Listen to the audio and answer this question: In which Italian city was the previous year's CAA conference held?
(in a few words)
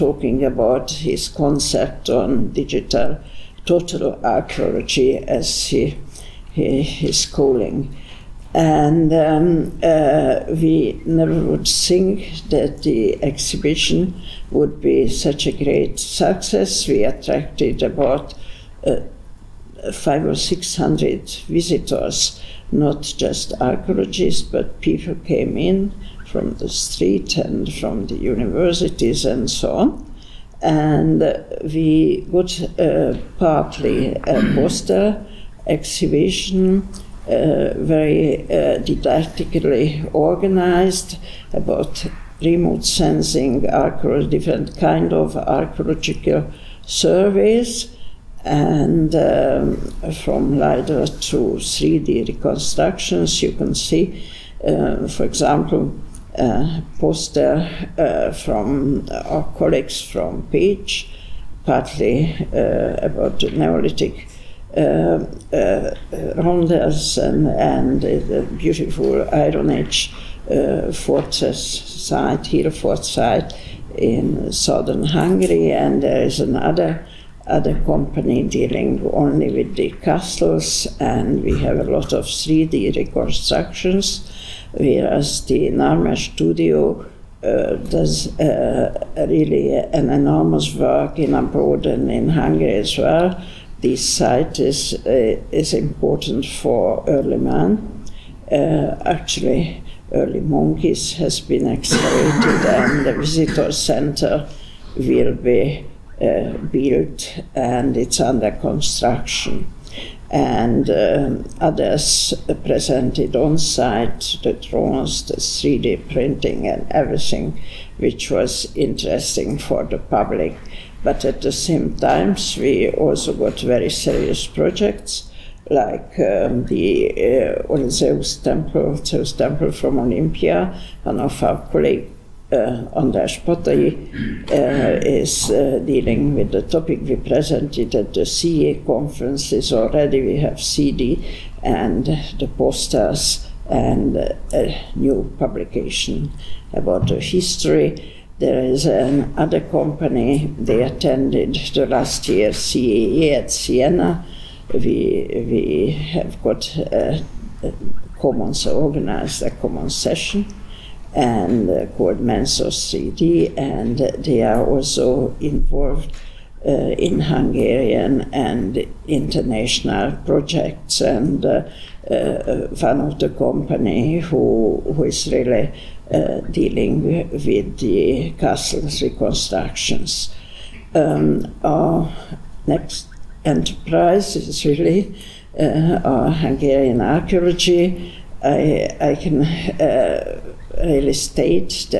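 Siena.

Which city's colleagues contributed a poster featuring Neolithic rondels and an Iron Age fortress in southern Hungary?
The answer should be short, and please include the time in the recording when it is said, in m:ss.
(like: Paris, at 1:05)
Pécs, at 1:00.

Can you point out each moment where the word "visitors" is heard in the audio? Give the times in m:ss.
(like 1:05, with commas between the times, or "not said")
0:21, 1:43.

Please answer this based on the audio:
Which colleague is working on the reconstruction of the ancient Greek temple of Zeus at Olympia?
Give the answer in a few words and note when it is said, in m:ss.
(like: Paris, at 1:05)
András Patay, at 2:12.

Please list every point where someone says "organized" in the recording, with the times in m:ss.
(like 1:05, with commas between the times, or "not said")
0:40, 2:38.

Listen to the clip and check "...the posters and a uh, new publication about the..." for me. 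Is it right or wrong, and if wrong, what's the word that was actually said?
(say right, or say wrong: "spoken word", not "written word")
right.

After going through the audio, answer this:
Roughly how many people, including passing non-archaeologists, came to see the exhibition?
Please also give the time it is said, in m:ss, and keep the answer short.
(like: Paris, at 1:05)
500 or 600, at 0:19.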